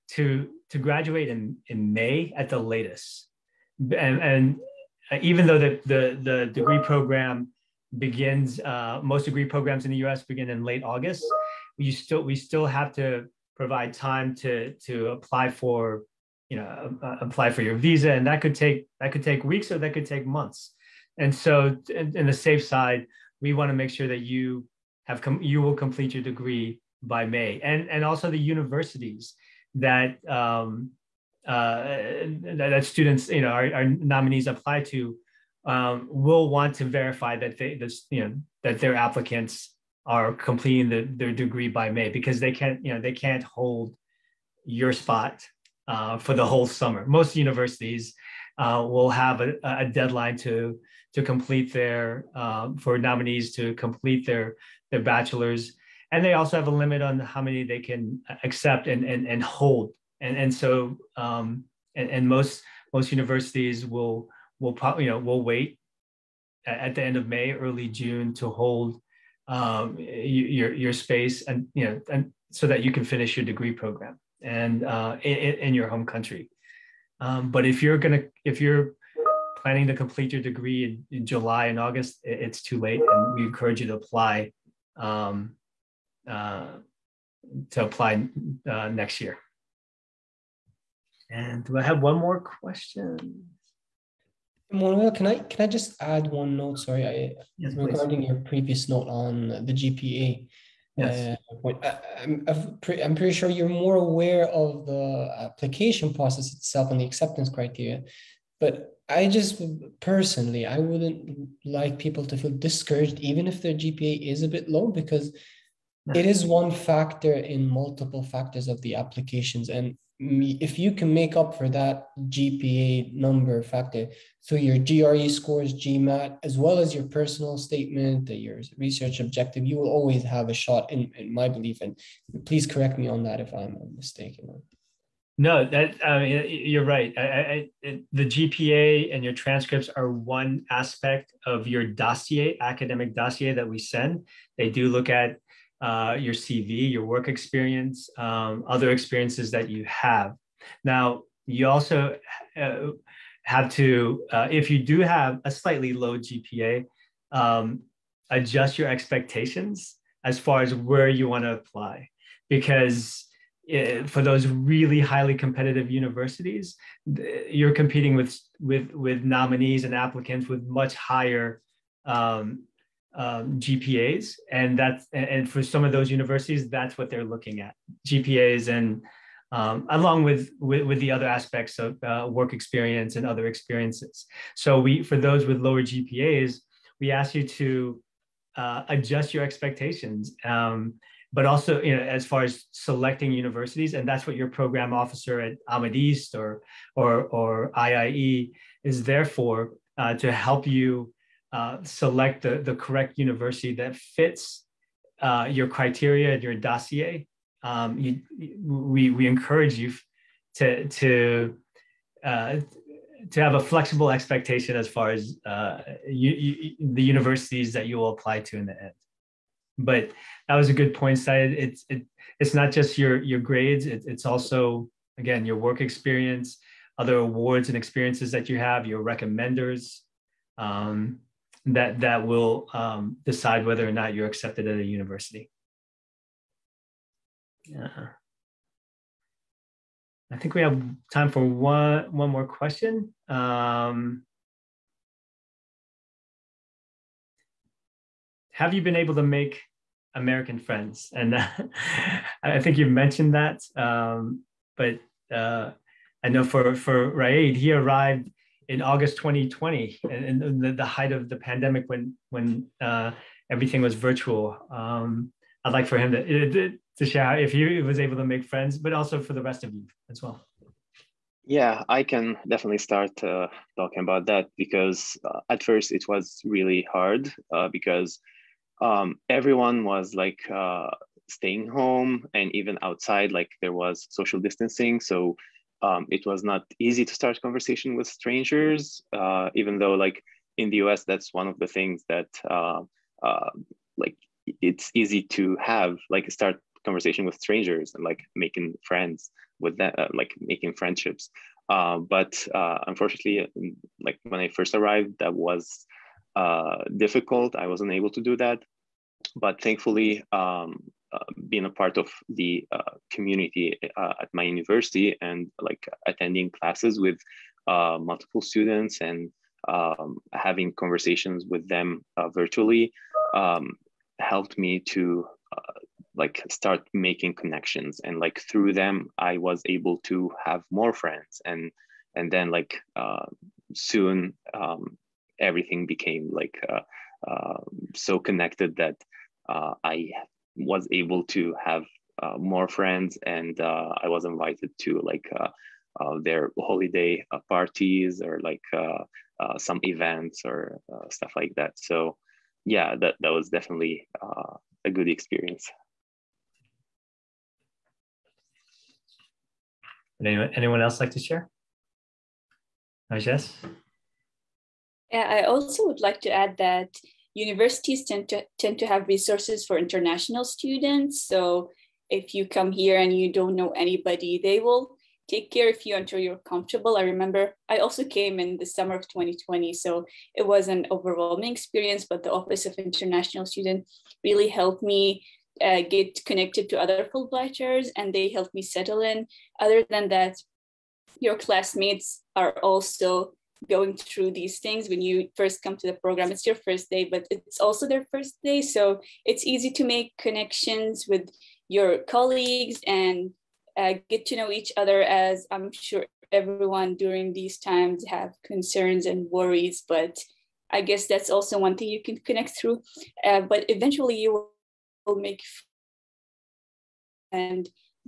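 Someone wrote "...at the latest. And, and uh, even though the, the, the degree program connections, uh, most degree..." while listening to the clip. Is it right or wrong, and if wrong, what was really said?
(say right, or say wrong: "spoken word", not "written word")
wrong: "begins", not "connections".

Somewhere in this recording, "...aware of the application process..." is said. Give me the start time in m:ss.
1:43.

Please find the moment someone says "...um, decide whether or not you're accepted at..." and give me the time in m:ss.
3:52.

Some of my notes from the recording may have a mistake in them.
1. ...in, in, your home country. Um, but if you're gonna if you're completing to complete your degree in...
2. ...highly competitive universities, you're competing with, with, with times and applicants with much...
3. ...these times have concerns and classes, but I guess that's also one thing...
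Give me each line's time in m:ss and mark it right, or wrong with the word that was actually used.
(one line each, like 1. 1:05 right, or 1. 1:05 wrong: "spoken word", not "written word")
1. 1:15 wrong: "planning", not "completing"
2. 2:44 wrong: "nominees", not "times"
3. 6:47 wrong: "worries", not "classes".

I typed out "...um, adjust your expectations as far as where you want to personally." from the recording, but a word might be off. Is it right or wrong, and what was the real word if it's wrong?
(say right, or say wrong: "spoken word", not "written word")
wrong: "apply", not "personally".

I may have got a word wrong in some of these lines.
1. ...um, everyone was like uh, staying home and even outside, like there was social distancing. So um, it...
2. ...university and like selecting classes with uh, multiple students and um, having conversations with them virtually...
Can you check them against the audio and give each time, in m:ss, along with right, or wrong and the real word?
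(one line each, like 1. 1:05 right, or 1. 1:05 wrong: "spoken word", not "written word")
1. 4:38 right
2. 5:14 wrong: "attending", not "selecting".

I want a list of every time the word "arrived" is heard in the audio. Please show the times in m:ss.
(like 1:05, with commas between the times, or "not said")
4:17, 5:04.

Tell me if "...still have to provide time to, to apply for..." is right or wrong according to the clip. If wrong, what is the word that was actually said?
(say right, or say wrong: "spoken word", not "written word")
right.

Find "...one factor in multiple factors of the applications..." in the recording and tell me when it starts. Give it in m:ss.
1:56.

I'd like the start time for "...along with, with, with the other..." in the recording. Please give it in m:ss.
2:59.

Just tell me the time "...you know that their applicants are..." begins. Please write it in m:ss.
0:38.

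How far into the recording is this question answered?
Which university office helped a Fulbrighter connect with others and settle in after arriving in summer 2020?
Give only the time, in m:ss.
6:22.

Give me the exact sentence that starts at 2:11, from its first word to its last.
And please correct me on that if I'm mistaken.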